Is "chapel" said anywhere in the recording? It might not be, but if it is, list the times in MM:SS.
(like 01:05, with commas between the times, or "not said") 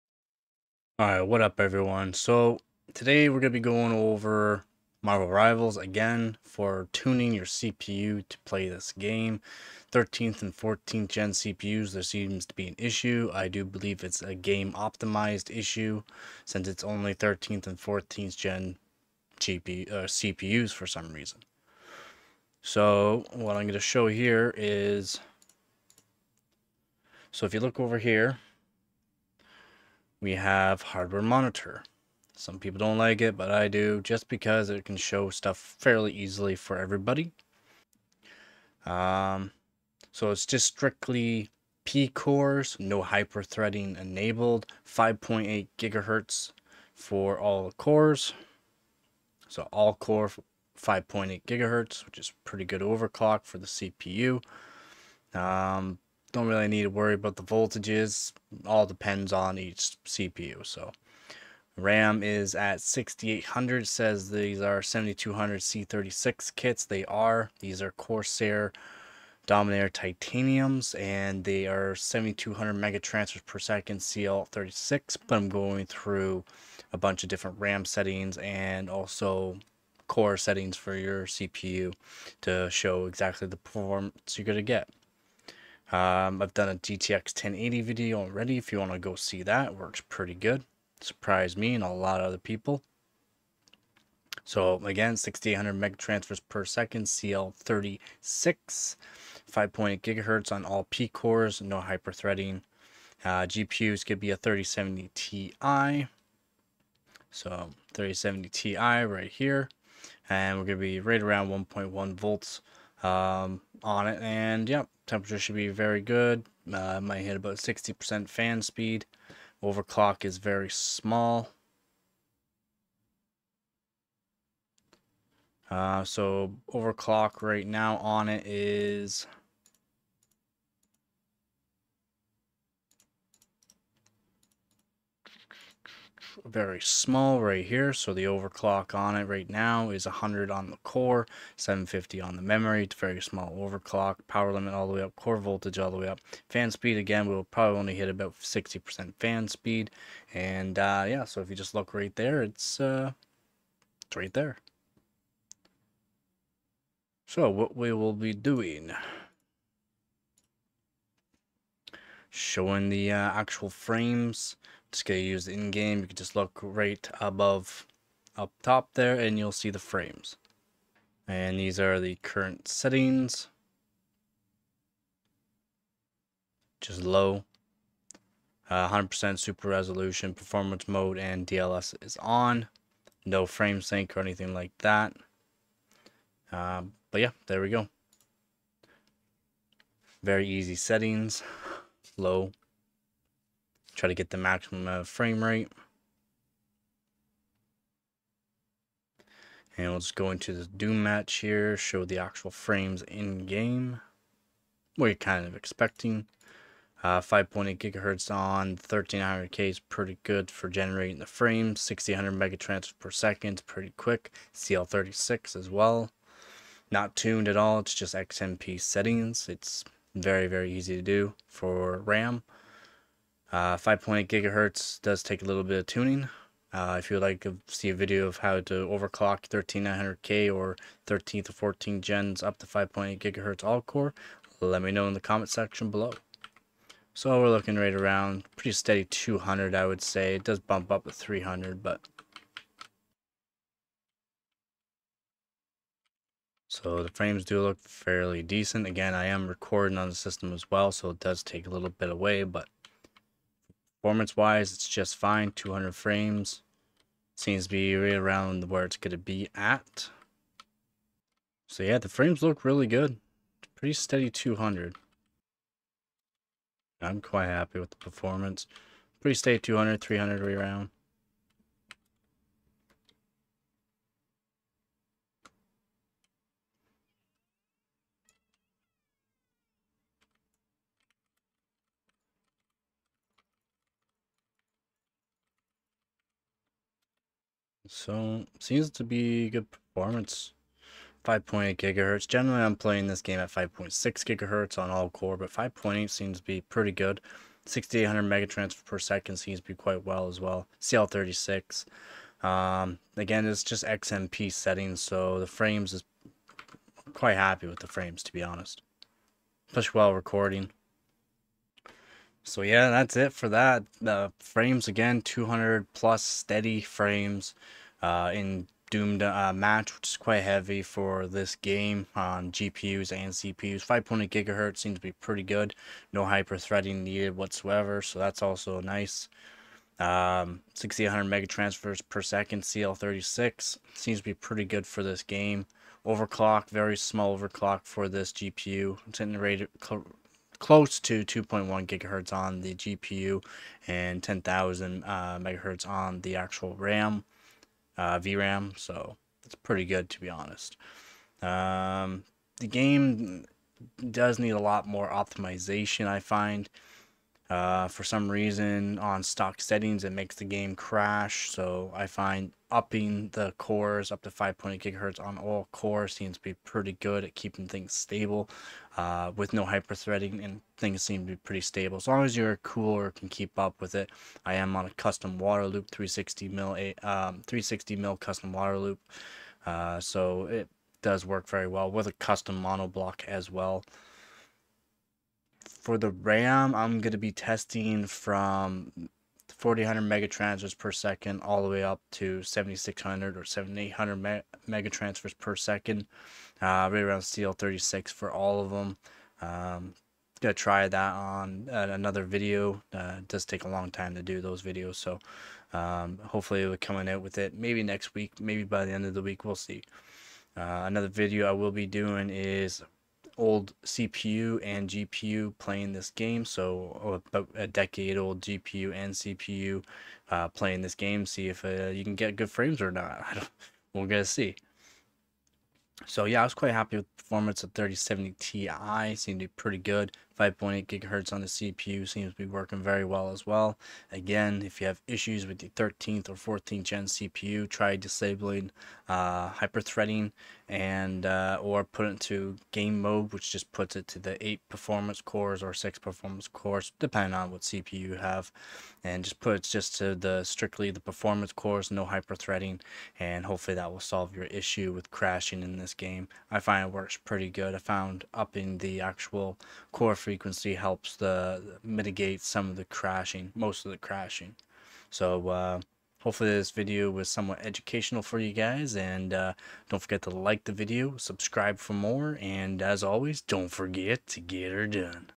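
not said.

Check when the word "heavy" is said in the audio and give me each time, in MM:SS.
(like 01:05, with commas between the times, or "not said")
05:20.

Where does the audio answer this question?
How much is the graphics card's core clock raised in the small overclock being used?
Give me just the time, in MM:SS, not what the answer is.
02:20.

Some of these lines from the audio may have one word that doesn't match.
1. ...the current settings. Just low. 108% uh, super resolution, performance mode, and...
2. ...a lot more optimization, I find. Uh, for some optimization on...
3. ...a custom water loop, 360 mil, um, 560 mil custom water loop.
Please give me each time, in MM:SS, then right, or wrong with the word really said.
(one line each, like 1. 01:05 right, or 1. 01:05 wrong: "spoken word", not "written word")
1. 02:51 wrong: "100", not "108"
2. 05:54 wrong: "reason", not "optimization"
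3. 06:14 wrong: "360", not "560".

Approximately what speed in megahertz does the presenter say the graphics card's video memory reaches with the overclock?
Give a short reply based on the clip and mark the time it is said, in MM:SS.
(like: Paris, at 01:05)
10,000 MHz, at 05:44.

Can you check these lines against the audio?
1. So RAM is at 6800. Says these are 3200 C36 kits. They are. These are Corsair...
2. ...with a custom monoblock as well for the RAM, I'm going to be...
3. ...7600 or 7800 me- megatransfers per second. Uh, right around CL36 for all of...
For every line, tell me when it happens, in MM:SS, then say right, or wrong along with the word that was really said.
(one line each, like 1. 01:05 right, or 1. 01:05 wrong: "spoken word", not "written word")
1. 01:00 wrong: "7200", not "3200"
2. 06:21 right
3. 06:32 right.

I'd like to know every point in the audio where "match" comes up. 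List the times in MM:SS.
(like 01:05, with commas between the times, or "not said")
03:21, 05:19.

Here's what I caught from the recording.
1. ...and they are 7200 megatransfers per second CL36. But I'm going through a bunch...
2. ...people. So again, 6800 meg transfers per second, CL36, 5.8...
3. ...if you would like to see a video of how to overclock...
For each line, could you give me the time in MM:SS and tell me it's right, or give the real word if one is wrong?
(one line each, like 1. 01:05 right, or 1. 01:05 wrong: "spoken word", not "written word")
1. 01:10 right
2. 01:32 right
3. 03:46 right.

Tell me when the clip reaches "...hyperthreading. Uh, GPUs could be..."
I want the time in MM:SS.
01:41.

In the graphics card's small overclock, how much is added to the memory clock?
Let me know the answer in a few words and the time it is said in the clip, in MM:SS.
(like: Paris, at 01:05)
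750, at 02:21.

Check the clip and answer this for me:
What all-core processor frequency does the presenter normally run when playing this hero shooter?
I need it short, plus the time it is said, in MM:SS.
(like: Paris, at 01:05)
5.6 GHz, at 04:53.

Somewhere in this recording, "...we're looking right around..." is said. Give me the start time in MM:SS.
03:57.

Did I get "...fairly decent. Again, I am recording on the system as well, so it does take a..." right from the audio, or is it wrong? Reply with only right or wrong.
right.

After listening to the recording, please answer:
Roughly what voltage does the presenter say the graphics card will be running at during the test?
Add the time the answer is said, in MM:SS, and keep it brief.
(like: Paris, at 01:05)
1.1 volts, at 01:51.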